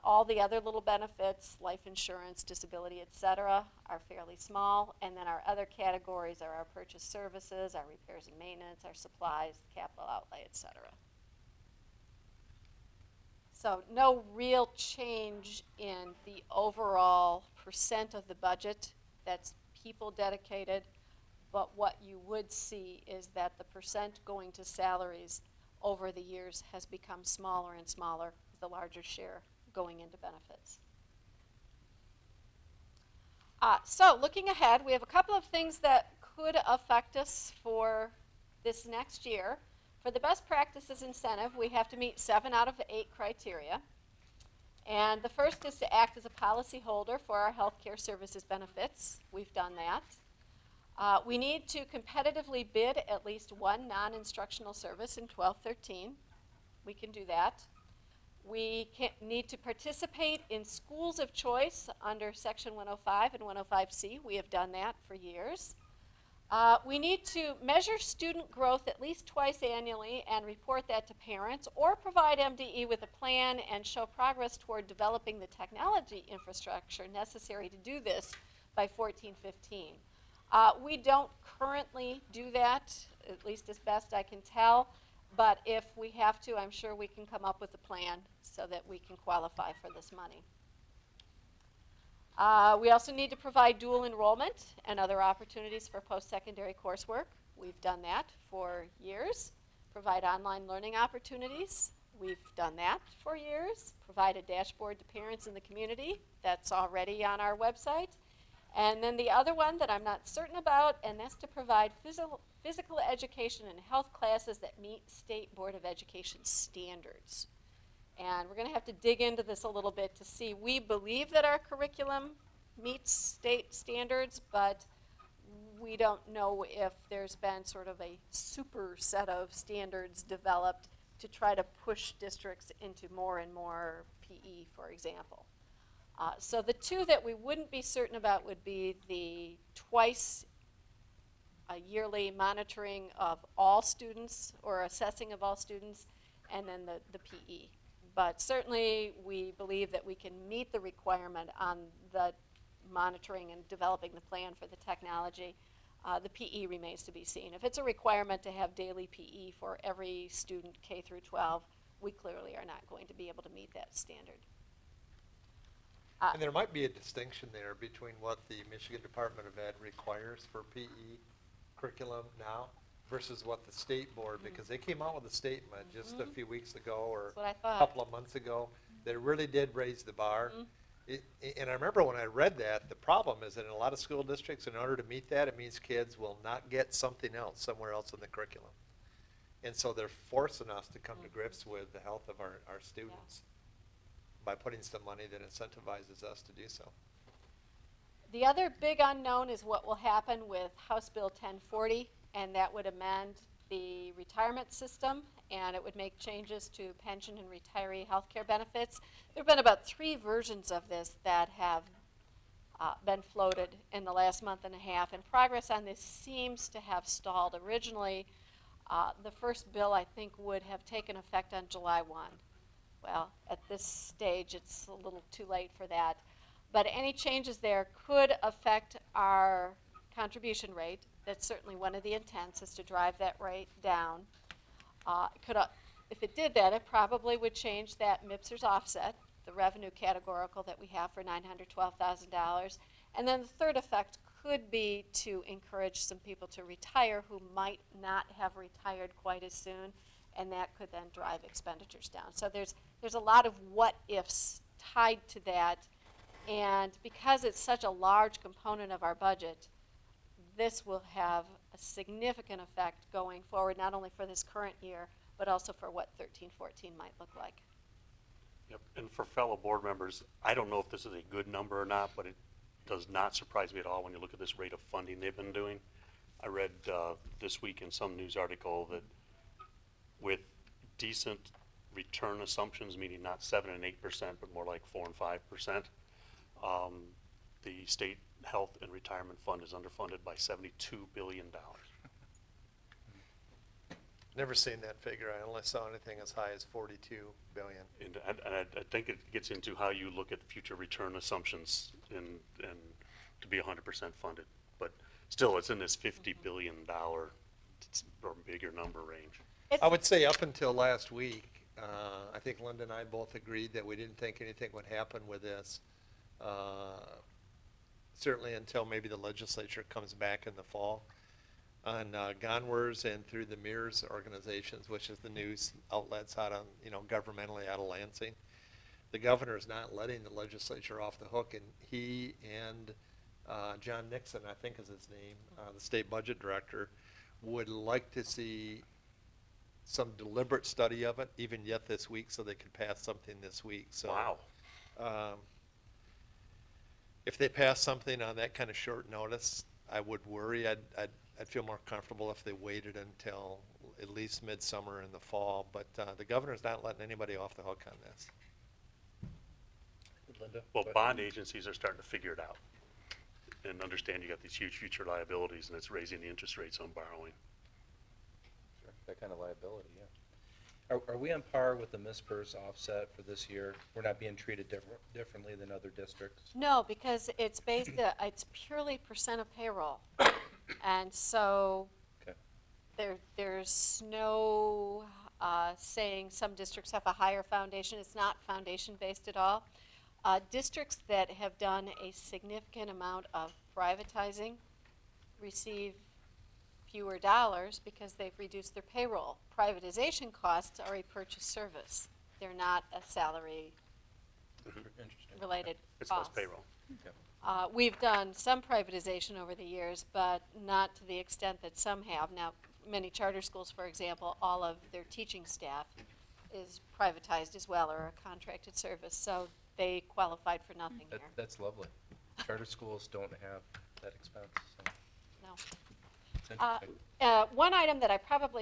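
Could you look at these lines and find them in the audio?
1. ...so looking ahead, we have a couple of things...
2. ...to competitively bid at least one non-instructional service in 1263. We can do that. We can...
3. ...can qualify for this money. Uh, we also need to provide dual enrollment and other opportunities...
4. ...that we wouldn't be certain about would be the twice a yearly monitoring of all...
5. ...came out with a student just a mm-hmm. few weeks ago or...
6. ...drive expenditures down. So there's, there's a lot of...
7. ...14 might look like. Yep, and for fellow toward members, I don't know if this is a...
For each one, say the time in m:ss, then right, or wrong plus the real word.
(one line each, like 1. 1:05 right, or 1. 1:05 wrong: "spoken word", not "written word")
1. 0:33 right
2. 0:51 wrong: "1213", not "1263"
3. 1:28 right
4. 2:17 right
5. 2:54 wrong: "statement", not "student"
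6. 4:11 right
7. 4:26 wrong: "board", not "toward".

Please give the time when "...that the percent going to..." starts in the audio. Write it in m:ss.
0:23.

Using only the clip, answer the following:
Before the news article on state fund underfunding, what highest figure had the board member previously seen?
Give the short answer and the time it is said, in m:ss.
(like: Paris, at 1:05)
$42 billion, at 4:56.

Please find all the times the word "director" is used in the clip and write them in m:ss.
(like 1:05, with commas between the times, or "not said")
5:36.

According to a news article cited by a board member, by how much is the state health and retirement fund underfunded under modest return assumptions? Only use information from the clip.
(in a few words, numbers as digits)
$72 billion.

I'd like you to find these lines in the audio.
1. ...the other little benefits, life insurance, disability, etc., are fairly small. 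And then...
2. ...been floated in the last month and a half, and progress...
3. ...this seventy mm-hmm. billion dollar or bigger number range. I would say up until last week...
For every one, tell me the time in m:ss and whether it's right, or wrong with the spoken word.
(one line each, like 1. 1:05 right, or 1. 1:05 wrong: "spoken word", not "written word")
1. 0:00 right
2. 3:33 right
3. 5:05 wrong: "fifty", not "seventy".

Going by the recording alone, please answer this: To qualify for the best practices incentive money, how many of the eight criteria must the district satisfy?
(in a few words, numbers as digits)
7.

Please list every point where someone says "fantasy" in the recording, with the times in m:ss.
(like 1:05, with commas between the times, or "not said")
not said.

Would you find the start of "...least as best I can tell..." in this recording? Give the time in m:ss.
1:23.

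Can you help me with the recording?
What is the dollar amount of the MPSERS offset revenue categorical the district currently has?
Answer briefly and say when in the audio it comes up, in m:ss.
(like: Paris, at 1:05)
$912,000, at 4:01.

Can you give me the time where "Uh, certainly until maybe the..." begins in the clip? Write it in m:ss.
5:16.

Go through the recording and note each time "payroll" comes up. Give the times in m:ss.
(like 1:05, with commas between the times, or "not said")
6:19, 6:38, 6:46.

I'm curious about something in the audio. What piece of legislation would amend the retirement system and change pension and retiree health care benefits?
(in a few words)
House Bill 1040.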